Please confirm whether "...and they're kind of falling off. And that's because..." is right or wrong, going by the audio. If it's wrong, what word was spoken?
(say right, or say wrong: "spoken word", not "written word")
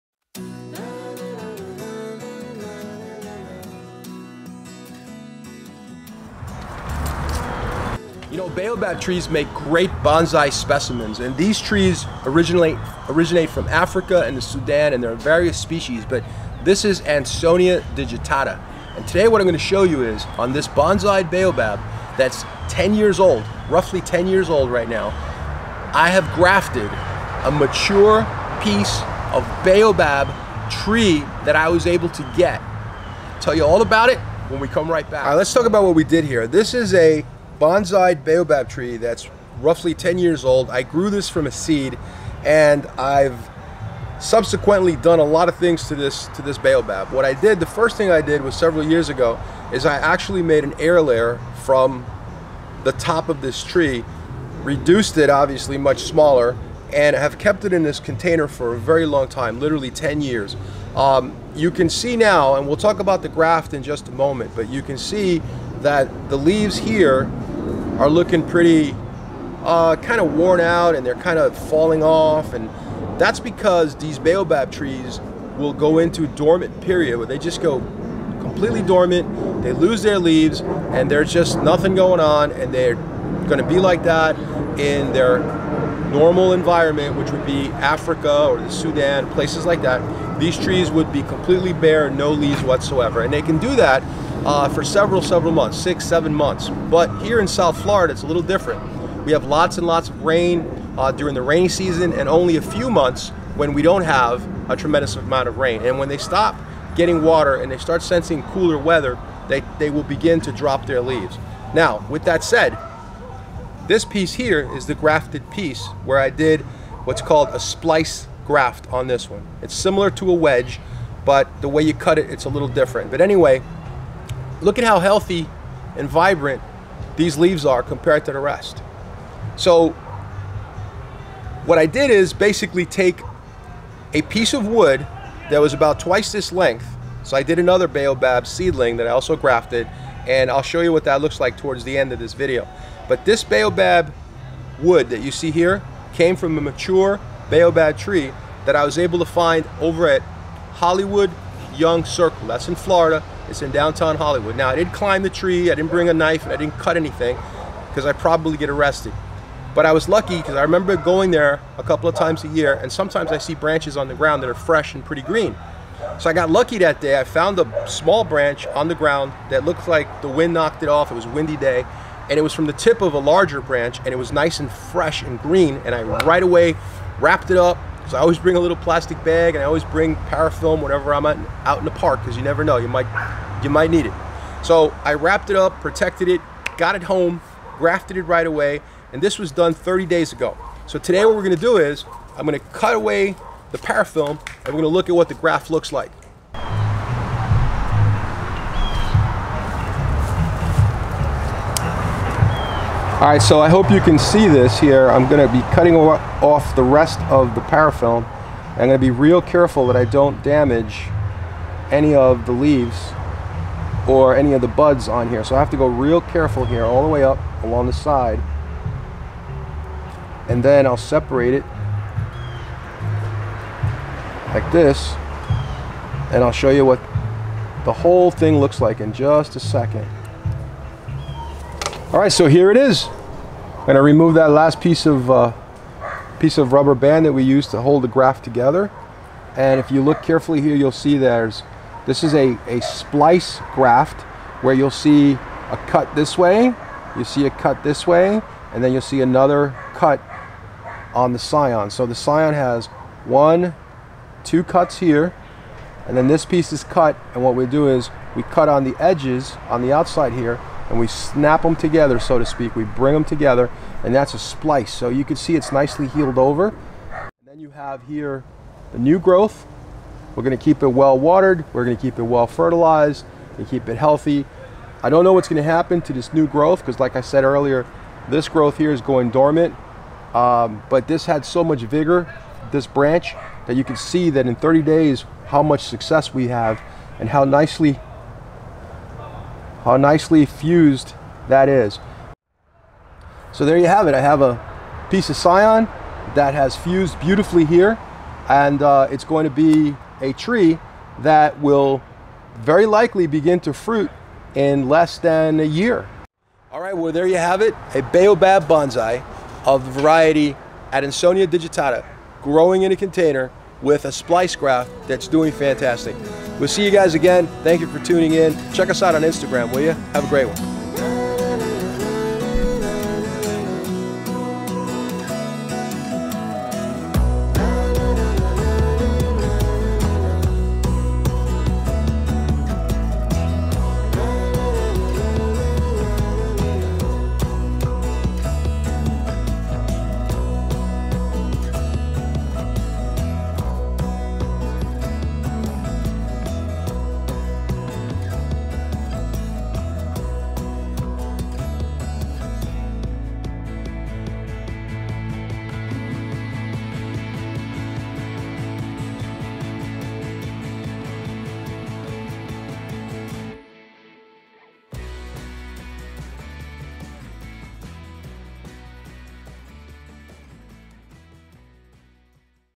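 right.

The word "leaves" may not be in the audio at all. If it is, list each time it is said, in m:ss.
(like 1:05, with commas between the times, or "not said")
1:06, 1:20, 1:32, 1:51, 2:07, 3:32.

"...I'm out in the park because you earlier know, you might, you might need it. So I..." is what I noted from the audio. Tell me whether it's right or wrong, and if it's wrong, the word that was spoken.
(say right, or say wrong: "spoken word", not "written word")
wrong: "never", not "earlier".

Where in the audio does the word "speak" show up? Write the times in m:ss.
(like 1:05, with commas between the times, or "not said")
4:22.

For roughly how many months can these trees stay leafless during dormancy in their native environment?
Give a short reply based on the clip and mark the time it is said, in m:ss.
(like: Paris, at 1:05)
6 to 7 months, at 1:35.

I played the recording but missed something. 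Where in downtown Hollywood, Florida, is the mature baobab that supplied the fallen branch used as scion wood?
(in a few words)
Hollywood Young Circle.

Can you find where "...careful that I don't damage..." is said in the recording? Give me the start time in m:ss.
3:29.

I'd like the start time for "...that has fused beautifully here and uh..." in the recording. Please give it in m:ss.
4:56.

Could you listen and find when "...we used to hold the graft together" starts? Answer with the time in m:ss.
3:57.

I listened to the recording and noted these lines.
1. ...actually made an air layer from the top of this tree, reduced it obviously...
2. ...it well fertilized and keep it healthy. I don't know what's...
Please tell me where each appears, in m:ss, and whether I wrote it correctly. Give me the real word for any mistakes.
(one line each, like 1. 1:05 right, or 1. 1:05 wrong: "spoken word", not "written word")
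1. 0:49 right
2. 4:32 right.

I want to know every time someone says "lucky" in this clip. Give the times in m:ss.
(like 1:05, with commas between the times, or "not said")
2:40, 2:46.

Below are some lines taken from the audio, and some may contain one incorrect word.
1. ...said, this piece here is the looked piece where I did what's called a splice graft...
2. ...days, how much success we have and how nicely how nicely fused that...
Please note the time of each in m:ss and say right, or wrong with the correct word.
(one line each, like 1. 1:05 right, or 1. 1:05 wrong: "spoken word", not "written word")
1. 1:52 wrong: "grafted", not "looked"
2. 4:44 right.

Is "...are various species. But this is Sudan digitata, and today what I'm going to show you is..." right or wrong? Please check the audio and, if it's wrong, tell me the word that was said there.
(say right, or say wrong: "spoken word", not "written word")
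wrong: "Adansonia", not "Sudan".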